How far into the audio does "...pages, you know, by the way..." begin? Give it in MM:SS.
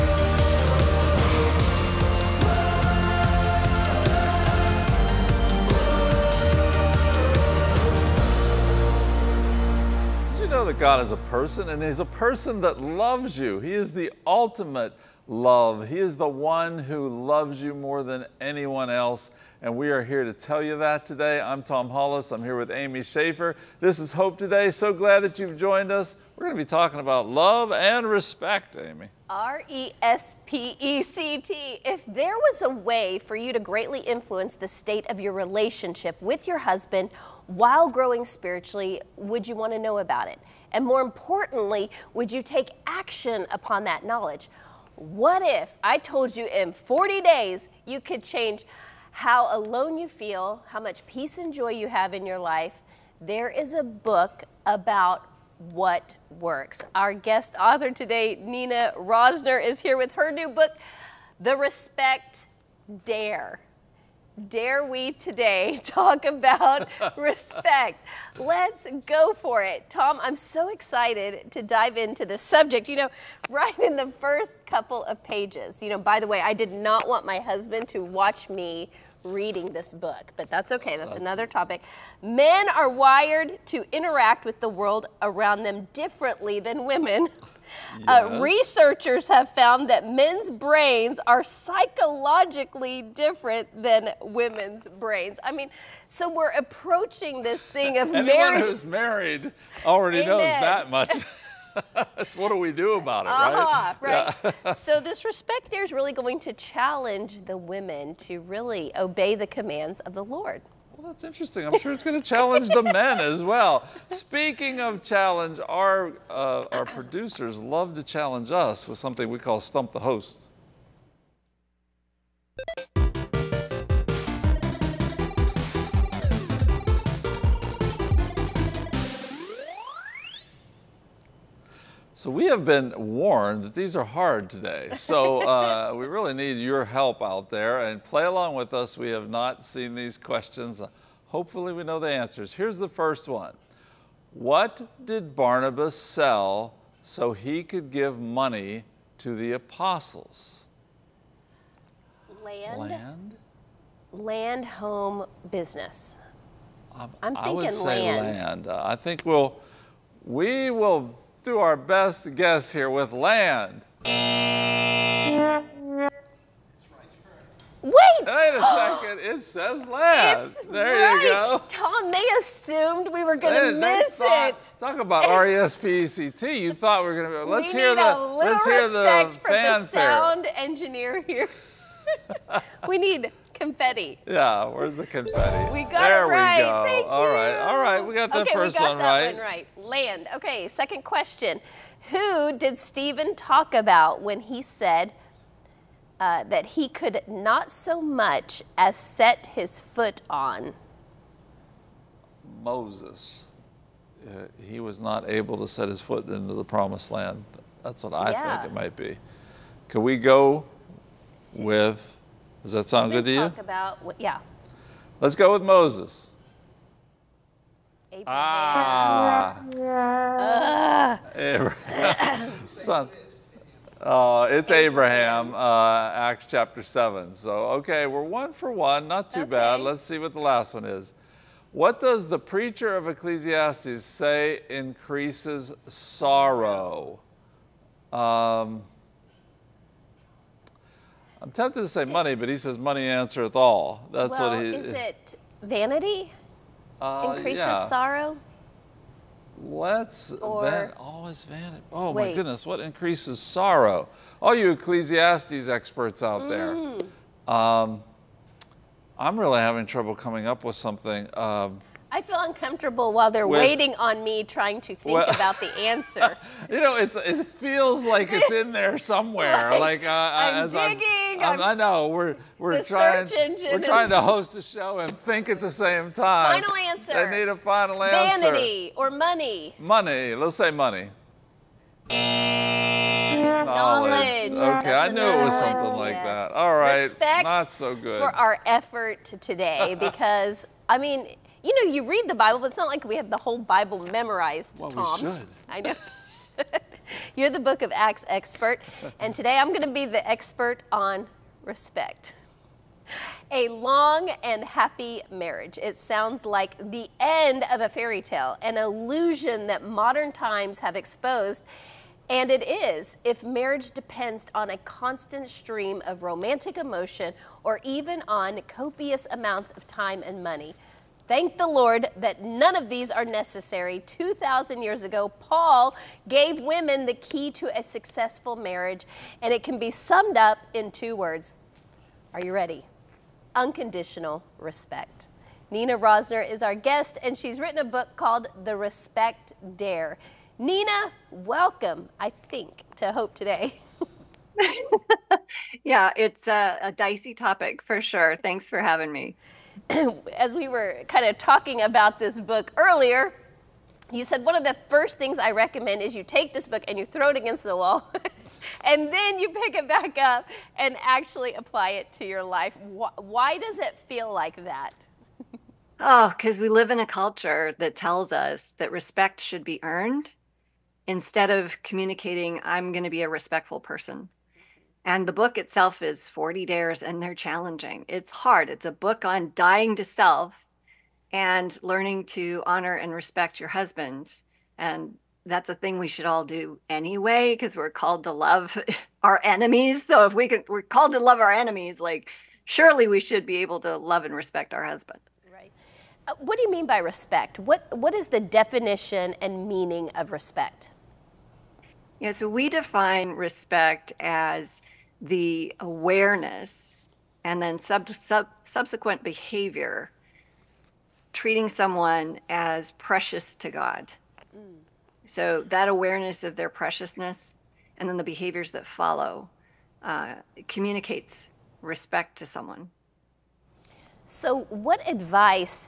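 01:15.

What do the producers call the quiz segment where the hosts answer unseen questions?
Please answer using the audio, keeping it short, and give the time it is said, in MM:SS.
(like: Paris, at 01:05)
Stump the Host, at 01:59.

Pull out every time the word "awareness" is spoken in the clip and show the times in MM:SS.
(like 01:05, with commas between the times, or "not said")
06:45, 06:55.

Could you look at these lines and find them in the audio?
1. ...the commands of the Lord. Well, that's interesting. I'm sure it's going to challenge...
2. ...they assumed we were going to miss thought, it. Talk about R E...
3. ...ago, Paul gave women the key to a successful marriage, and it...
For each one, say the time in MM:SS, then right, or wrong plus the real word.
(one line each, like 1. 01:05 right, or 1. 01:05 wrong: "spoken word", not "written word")
1. 01:49 right
2. 02:52 right
3. 05:25 right.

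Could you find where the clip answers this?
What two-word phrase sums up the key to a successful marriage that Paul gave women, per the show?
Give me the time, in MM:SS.
05:33.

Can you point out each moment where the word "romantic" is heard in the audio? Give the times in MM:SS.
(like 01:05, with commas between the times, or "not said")
05:16.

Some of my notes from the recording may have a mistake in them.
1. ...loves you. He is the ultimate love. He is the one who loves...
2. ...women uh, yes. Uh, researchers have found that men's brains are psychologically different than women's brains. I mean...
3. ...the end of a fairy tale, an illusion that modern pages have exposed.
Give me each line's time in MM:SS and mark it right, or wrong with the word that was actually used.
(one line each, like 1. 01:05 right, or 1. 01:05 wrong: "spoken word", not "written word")
1. 00:12 right
2. 01:26 right
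3. 05:06 wrong: "times", not "pages".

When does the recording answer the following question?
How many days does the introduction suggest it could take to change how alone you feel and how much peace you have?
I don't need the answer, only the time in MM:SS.
00:46.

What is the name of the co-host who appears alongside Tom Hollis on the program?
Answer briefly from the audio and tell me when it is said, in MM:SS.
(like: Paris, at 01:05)
Amy Schaefer, at 00:22.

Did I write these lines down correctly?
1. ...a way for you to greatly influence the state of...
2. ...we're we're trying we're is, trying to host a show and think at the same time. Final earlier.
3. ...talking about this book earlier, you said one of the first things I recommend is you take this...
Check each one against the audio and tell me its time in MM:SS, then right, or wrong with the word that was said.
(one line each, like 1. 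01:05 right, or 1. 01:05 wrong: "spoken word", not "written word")
1. 00:32 right
2. 04:32 wrong: "answer", not "earlier"
3. 05:51 right.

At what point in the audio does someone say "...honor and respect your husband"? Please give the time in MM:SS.
06:22.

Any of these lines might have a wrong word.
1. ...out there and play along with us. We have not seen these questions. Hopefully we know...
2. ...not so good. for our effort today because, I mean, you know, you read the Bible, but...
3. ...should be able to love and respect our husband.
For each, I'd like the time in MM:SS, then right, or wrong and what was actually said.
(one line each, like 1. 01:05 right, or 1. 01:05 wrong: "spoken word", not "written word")
1. 02:17 right
2. 04:47 right
3. 06:33 right.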